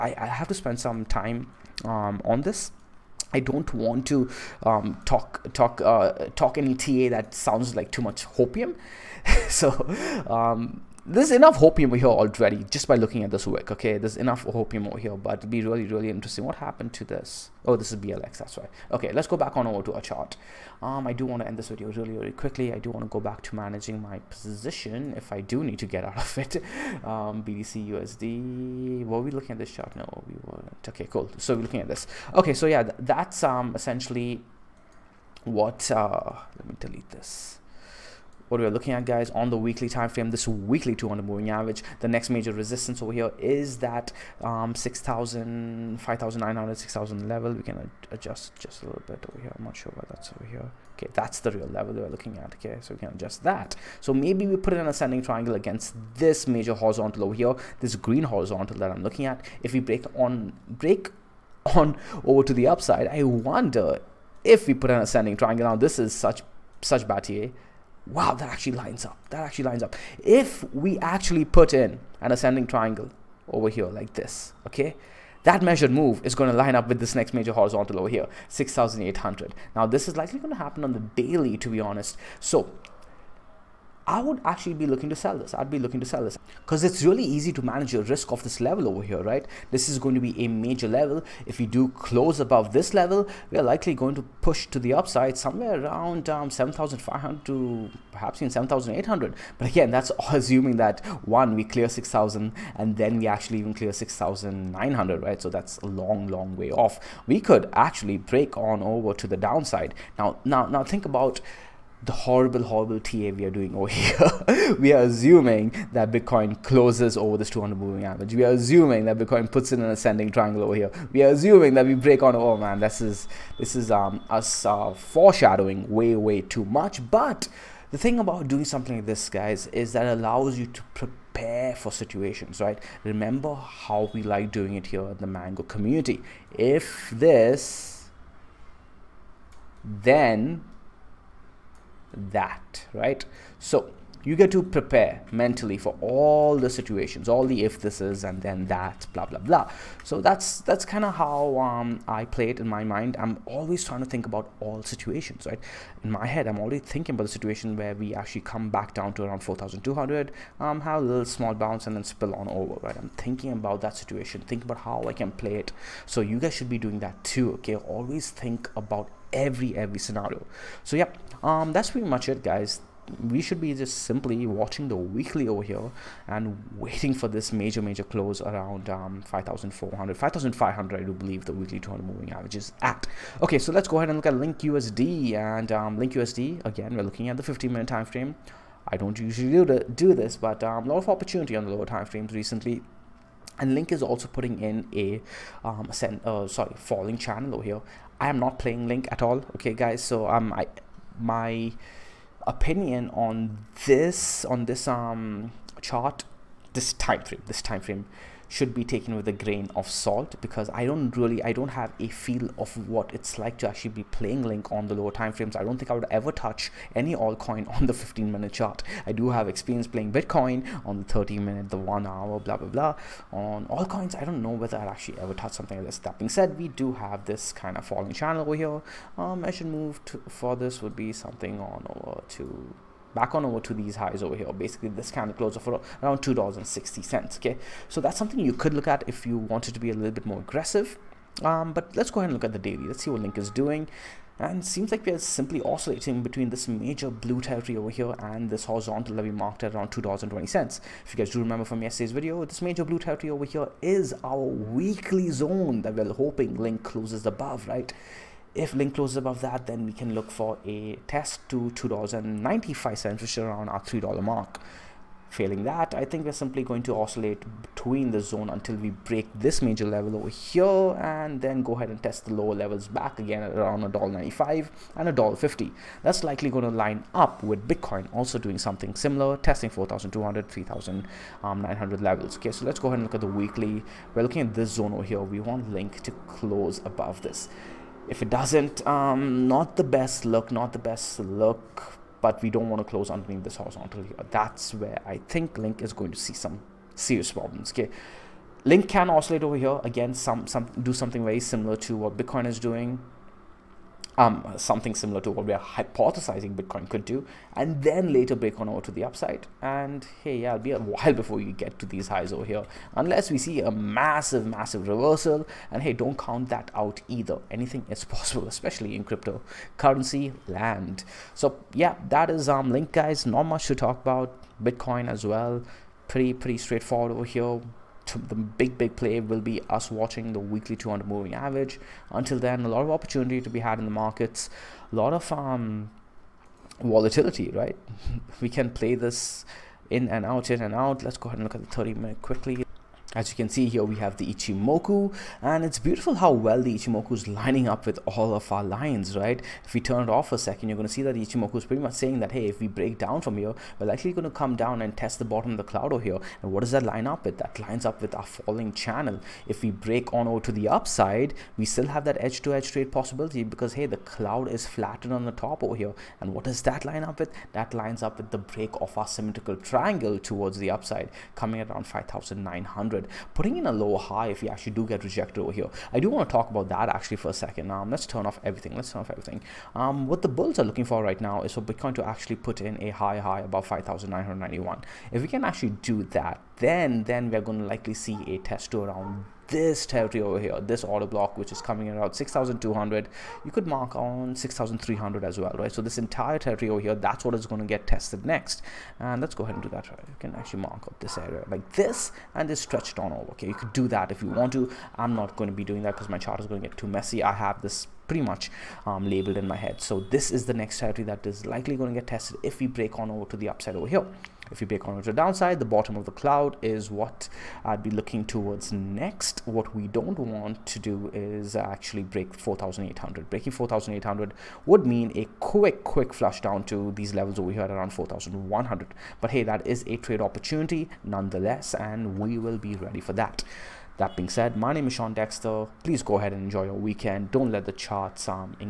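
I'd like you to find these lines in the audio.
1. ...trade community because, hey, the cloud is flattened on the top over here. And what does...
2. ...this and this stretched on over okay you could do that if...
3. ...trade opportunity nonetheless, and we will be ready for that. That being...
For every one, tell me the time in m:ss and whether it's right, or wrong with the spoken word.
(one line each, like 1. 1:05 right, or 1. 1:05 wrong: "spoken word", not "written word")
1. 6:02 wrong: "possibility", not "community"
2. 6:41 right
3. 7:09 right.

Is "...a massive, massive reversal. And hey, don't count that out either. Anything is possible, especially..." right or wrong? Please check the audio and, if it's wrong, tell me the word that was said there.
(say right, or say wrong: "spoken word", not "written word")
right.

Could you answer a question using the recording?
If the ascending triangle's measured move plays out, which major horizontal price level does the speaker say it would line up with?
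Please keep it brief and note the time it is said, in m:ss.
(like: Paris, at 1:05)
6,800, at 1:18.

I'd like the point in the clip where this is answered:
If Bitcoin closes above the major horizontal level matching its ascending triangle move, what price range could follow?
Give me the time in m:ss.
1:36.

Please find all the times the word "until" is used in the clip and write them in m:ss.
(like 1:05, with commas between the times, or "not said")
4:28, 5:32.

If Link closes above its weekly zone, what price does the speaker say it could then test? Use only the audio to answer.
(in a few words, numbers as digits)
$2.95.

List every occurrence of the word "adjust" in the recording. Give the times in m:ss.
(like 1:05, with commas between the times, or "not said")
0:48, 0:53.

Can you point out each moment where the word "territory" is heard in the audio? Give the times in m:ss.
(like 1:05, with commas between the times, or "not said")
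4:07, 4:12, 6:29, 6:36, 6:50.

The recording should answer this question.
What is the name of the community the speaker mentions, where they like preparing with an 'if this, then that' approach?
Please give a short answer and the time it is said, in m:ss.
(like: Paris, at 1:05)
Mango community, at 2:15.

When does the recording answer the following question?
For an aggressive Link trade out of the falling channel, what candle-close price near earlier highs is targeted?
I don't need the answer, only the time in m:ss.
3:56.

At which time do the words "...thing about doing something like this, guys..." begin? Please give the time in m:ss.
2:07.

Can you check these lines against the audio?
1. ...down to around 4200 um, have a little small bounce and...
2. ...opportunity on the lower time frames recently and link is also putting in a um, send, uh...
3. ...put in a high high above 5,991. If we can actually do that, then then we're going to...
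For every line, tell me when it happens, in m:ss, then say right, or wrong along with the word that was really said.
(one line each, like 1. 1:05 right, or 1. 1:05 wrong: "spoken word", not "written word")
1. 2:38 right
2. 3:11 right
3. 6:22 right.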